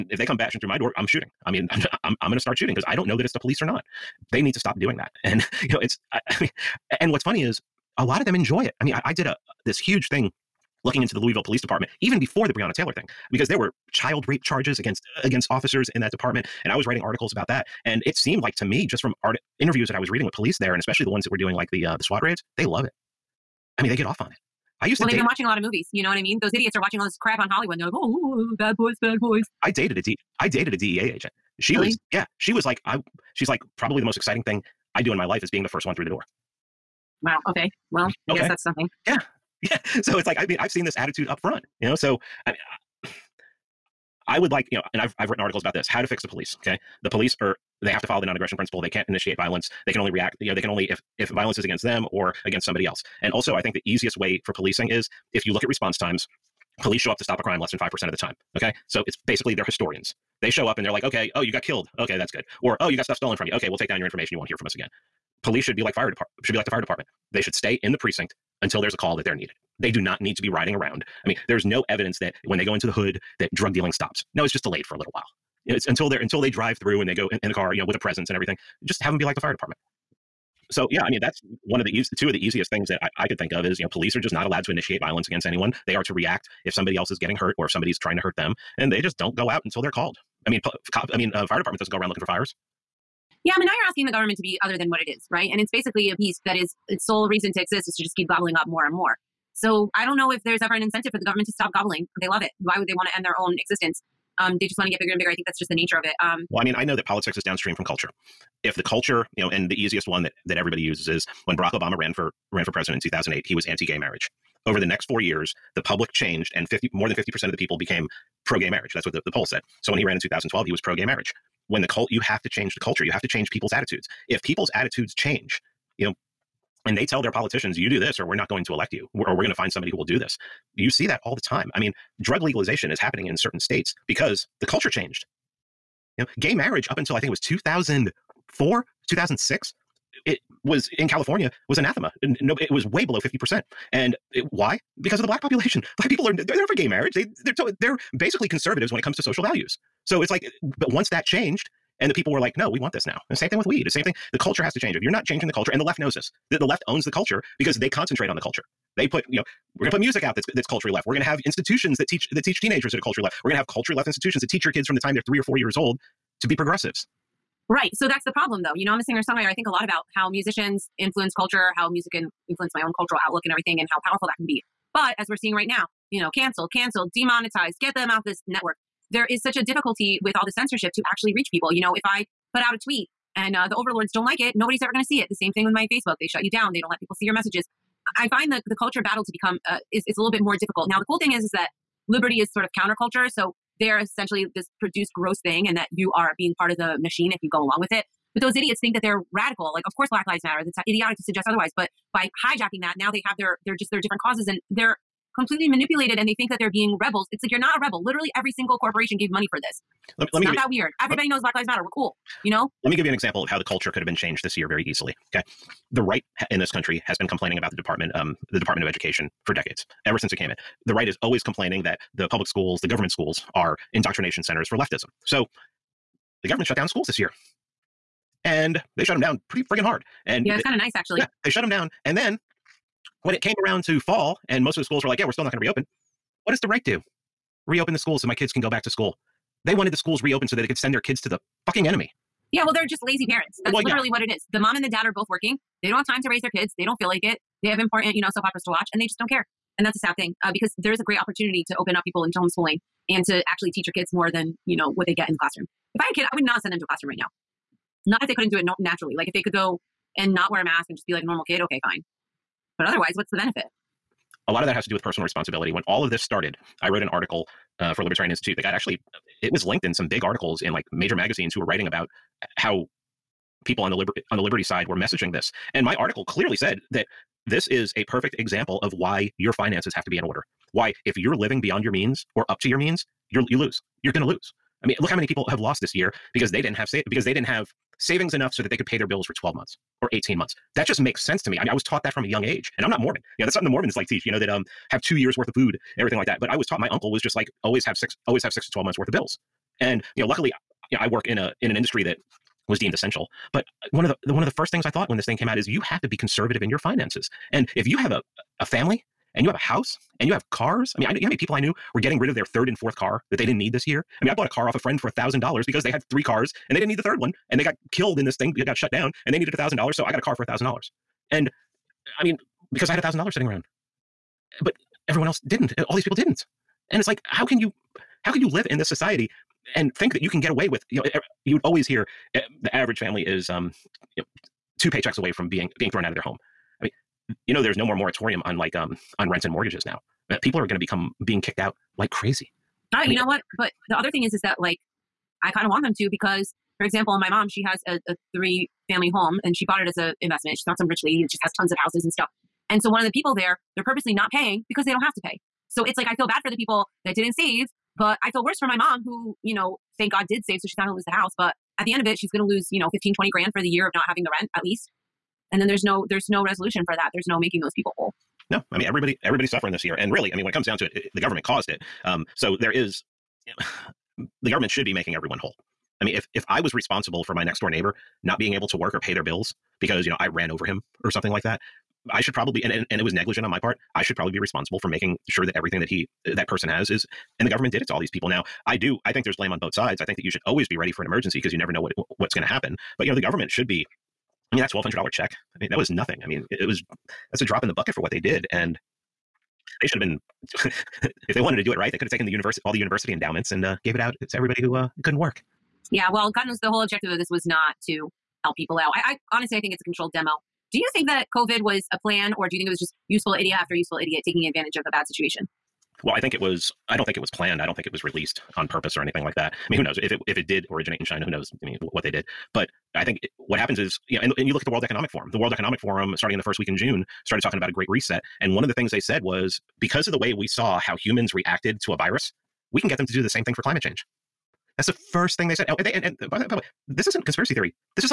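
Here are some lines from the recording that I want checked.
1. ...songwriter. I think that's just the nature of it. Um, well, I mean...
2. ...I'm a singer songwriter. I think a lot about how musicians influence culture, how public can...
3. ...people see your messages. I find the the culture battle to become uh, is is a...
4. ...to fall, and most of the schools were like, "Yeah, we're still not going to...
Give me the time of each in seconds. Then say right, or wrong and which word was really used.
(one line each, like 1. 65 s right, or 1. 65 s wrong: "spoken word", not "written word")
1. 105 s wrong: "bigger", not "songwriter"
2. 168 s wrong: "music", not "public"
3. 187 s right
4. 233 s right.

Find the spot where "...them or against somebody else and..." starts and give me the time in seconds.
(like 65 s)
51 s.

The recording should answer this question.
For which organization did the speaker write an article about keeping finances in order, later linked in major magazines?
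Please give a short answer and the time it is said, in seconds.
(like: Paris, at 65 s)
Libertarian Institute, at 268 s.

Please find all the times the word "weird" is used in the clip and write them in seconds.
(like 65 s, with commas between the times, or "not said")
210 s.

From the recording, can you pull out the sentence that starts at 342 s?
I, I mean, you know what?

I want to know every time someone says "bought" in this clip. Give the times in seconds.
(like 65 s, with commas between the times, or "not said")
314 s, 349 s.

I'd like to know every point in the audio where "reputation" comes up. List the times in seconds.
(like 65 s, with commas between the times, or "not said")
not said.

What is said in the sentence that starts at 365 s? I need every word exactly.
And then there's no there's no resolution for that.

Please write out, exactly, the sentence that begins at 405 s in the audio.
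Yeah, well, God knows the whole objective of this was not to help people out.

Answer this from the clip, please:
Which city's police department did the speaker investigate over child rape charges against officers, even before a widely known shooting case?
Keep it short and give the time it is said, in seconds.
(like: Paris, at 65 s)
Louisville, at 11 s.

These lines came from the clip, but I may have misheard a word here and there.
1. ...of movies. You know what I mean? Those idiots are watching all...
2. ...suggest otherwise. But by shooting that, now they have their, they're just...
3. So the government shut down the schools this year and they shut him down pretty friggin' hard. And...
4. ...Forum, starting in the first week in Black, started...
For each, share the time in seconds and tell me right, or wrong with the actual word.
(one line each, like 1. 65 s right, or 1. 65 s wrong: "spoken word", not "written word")
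1. 25 s right
2. 201 s wrong: "hijacking", not "shooting"
3. 225 s right
4. 425 s wrong: "June", not "Black".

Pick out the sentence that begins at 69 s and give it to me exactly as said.
They do not need to be riding around.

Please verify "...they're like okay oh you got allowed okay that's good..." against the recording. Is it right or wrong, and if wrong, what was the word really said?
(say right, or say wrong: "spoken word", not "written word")
wrong: "killed", not "allowed".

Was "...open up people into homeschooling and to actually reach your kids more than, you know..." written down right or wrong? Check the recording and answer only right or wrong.
wrong.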